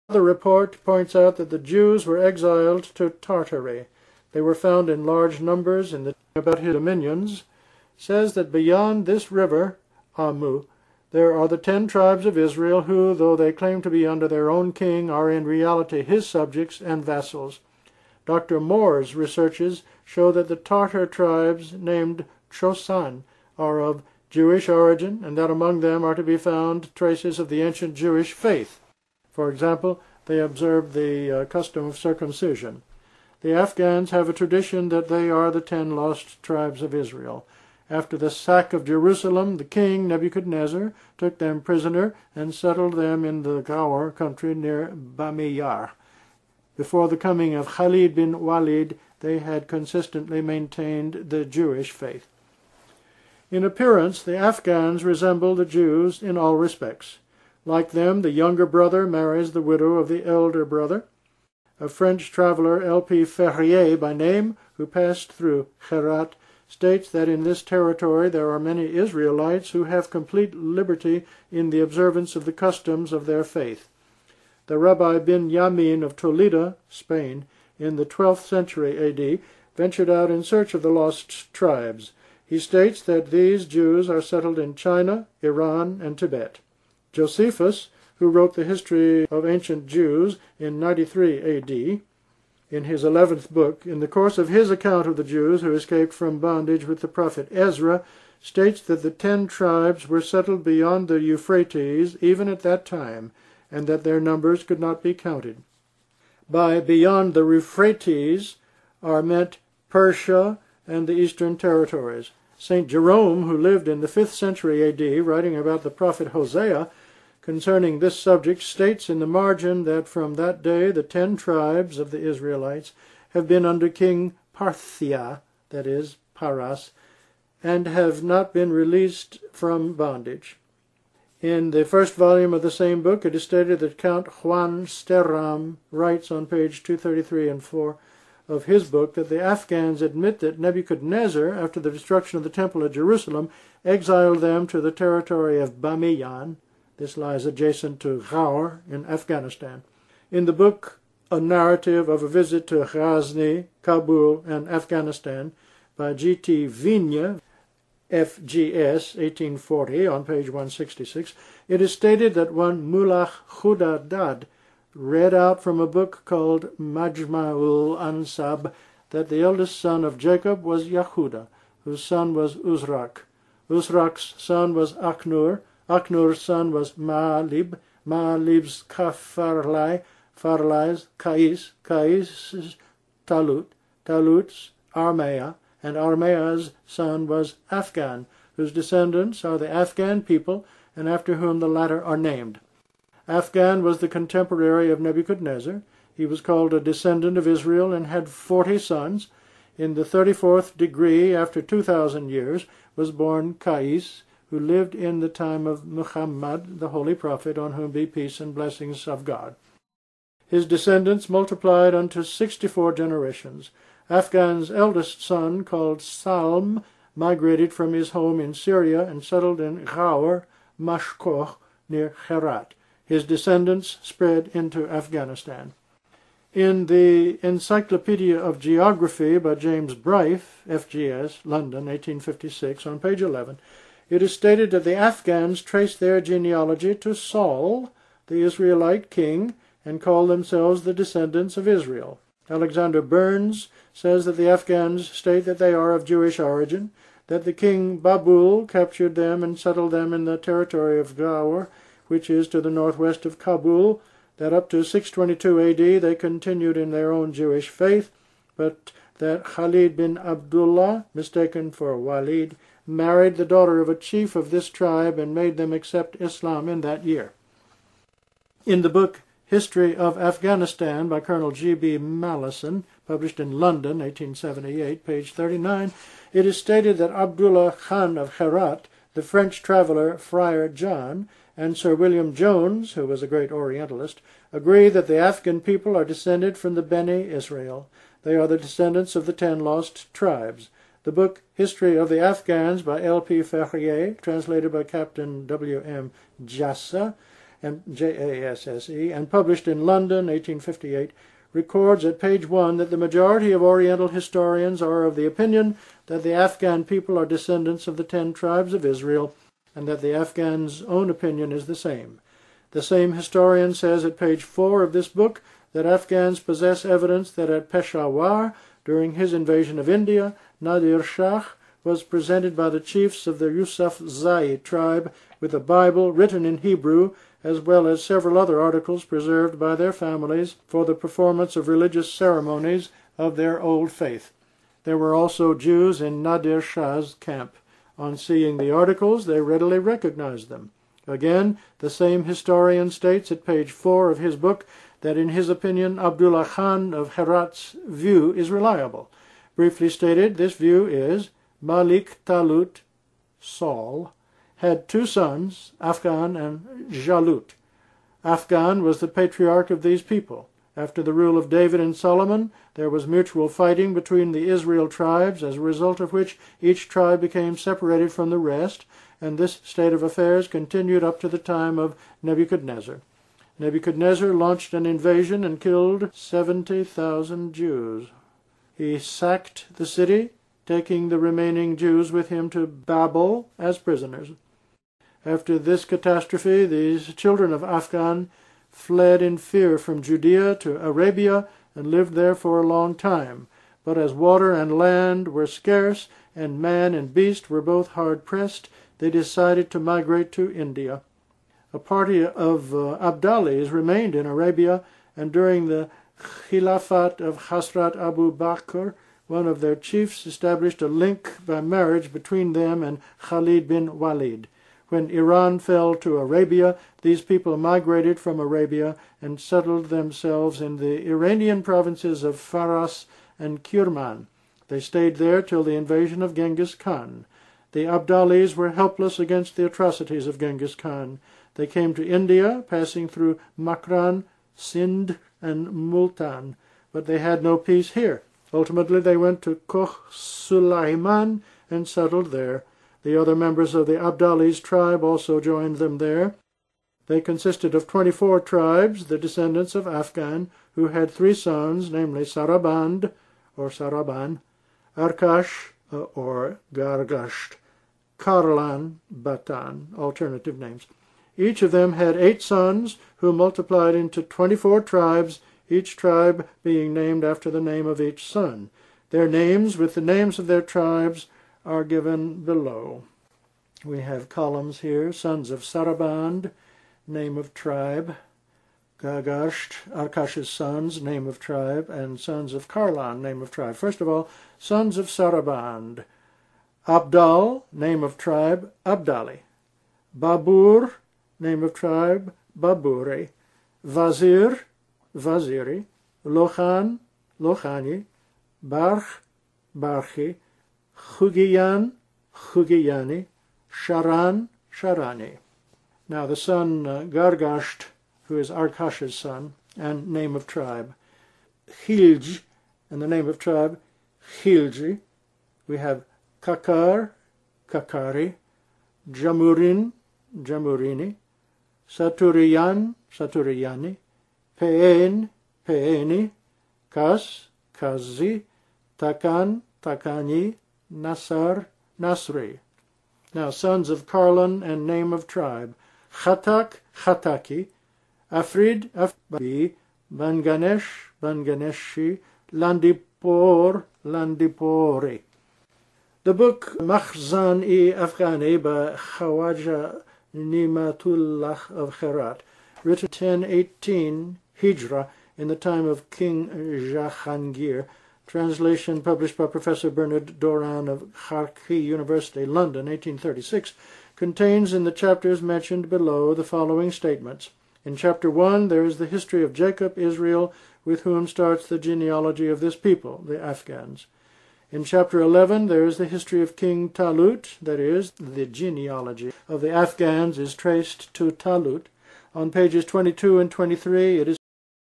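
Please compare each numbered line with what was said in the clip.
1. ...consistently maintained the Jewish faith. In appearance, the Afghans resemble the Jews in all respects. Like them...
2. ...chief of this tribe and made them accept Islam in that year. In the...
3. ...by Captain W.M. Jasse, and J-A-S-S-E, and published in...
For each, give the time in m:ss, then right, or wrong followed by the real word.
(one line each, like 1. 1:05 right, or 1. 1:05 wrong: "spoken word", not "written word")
1. 0:49 right
2. 4:23 right
3. 4:54 right.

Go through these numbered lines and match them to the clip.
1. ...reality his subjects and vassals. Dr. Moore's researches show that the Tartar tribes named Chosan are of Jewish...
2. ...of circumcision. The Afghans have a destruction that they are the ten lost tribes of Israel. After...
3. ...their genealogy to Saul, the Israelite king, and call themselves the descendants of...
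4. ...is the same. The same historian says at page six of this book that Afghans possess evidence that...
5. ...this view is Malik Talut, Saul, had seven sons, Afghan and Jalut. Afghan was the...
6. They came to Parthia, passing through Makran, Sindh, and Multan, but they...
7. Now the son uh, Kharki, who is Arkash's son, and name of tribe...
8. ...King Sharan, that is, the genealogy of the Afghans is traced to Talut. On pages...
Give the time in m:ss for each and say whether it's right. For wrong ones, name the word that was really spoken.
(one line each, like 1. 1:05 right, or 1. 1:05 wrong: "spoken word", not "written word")
1. 0:15 right
2. 0:31 wrong: "tradition", not "destruction"
3. 3:55 right
4. 5:11 wrong: "four", not "six"
5. 5:50 wrong: "two", not "seven"
6. 7:11 wrong: "India", not "Parthia"
7. 8:26 wrong: "Gargasht", not "Kharki"
8. 9:36 wrong: "Talut", not "Sharan".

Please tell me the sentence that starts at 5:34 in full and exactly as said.
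There were also Jews in Nadir Shah's camp.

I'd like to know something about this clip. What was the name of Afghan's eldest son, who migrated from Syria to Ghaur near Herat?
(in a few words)
Salm.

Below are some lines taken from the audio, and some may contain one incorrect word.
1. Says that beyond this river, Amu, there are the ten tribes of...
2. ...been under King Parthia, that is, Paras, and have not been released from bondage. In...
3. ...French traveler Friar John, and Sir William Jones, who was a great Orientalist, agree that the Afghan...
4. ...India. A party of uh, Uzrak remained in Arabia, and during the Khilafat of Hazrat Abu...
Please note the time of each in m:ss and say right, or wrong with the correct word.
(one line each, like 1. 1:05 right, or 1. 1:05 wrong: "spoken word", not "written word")
1. 0:07 right
2. 2:03 right
3. 4:39 right
4. 6:40 wrong: "Abdalis", not "Uzrak".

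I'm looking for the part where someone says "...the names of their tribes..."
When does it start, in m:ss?
7:49.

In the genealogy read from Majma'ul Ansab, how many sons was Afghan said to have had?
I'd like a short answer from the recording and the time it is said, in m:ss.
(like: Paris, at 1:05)
40, at 3:18.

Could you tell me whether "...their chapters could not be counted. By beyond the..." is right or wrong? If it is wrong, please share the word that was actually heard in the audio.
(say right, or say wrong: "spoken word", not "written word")
wrong: "numbers", not "chapters".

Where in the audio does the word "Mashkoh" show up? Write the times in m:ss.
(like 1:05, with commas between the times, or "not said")
3:40.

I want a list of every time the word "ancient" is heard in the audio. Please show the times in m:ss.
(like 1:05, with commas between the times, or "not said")
0:27, 1:29.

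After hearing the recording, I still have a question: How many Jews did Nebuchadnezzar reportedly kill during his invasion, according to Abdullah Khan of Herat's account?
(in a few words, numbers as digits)
70,000.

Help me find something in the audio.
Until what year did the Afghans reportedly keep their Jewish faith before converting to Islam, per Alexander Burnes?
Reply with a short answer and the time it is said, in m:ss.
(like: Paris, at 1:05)
622 AD, at 4:14.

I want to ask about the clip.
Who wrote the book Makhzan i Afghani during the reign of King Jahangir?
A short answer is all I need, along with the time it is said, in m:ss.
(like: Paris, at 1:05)
Khawaja Nimatullah, at 9:08.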